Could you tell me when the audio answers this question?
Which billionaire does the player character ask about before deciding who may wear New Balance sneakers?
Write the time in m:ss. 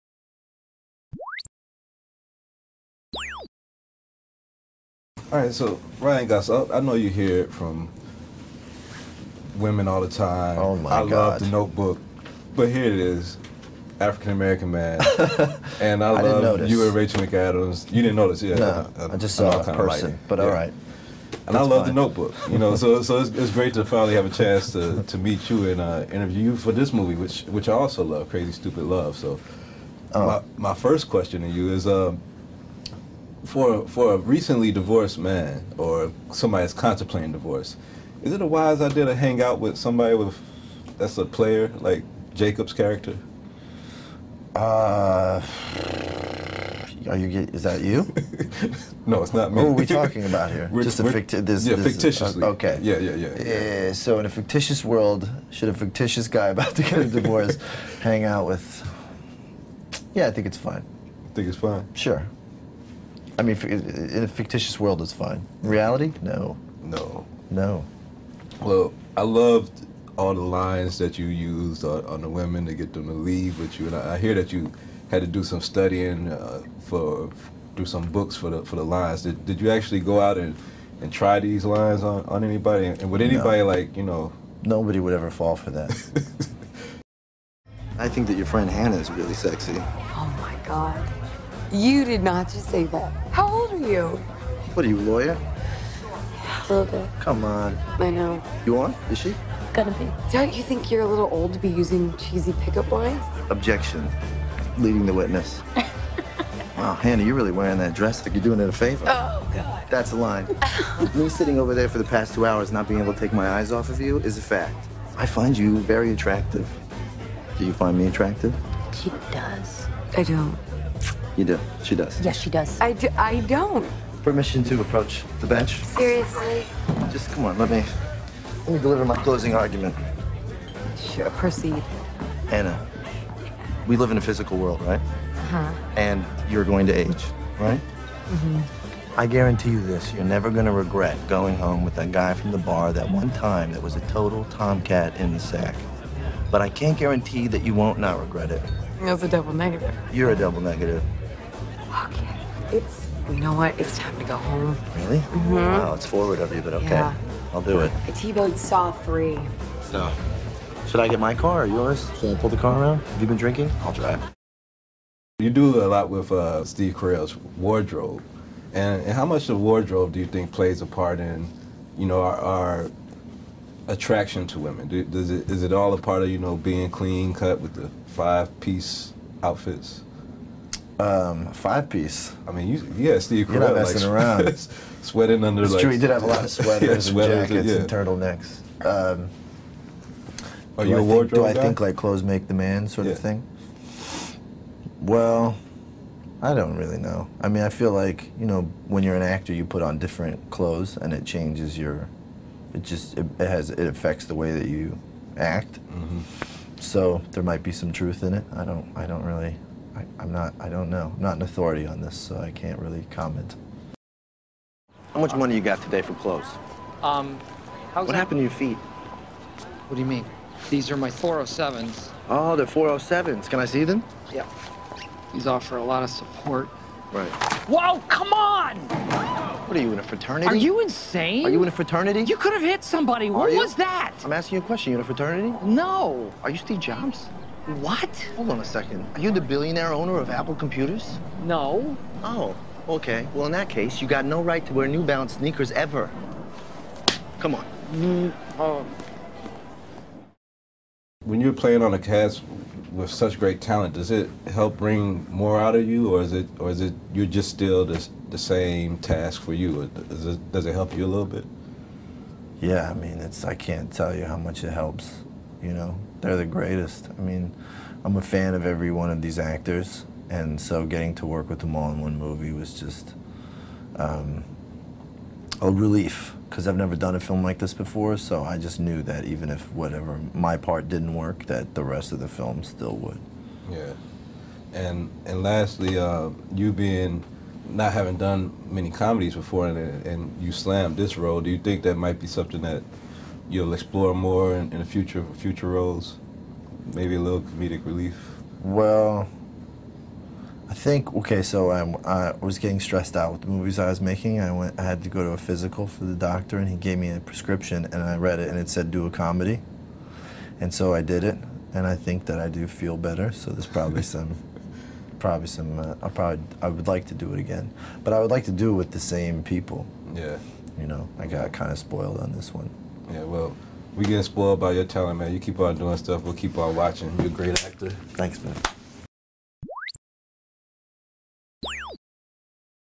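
3:56.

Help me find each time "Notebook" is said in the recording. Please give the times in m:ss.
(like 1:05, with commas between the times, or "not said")
0:11, 0:22.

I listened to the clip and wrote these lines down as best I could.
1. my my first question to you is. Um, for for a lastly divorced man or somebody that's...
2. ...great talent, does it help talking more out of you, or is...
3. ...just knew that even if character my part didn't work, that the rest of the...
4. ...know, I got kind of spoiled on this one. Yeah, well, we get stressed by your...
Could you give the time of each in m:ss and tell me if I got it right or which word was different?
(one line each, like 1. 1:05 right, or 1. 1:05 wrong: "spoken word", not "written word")
1. 0:30 wrong: "recently", not "lastly"
2. 4:13 wrong: "bring", not "talking"
3. 4:38 wrong: "whatever", not "character"
4. 5:20 wrong: "spoiled", not "stressed".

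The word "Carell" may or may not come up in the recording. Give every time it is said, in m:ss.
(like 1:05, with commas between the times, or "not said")
2:46, 3:03.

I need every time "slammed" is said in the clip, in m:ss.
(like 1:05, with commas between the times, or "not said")
4:50.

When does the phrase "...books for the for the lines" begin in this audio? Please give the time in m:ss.
1:18.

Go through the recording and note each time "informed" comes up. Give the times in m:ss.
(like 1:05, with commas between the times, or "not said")
not said.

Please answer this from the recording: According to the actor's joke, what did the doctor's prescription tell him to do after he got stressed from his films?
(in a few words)
Do a comedy.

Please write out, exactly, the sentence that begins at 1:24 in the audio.
Nobody would ever fall for that.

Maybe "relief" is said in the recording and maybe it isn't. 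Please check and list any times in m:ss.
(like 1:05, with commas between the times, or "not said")
4:35, 4:57.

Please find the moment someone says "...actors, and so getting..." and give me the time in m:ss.
4:29.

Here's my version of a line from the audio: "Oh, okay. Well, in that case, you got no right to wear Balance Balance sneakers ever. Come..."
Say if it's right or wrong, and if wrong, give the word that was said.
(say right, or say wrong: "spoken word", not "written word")
wrong: "New", not "Balance".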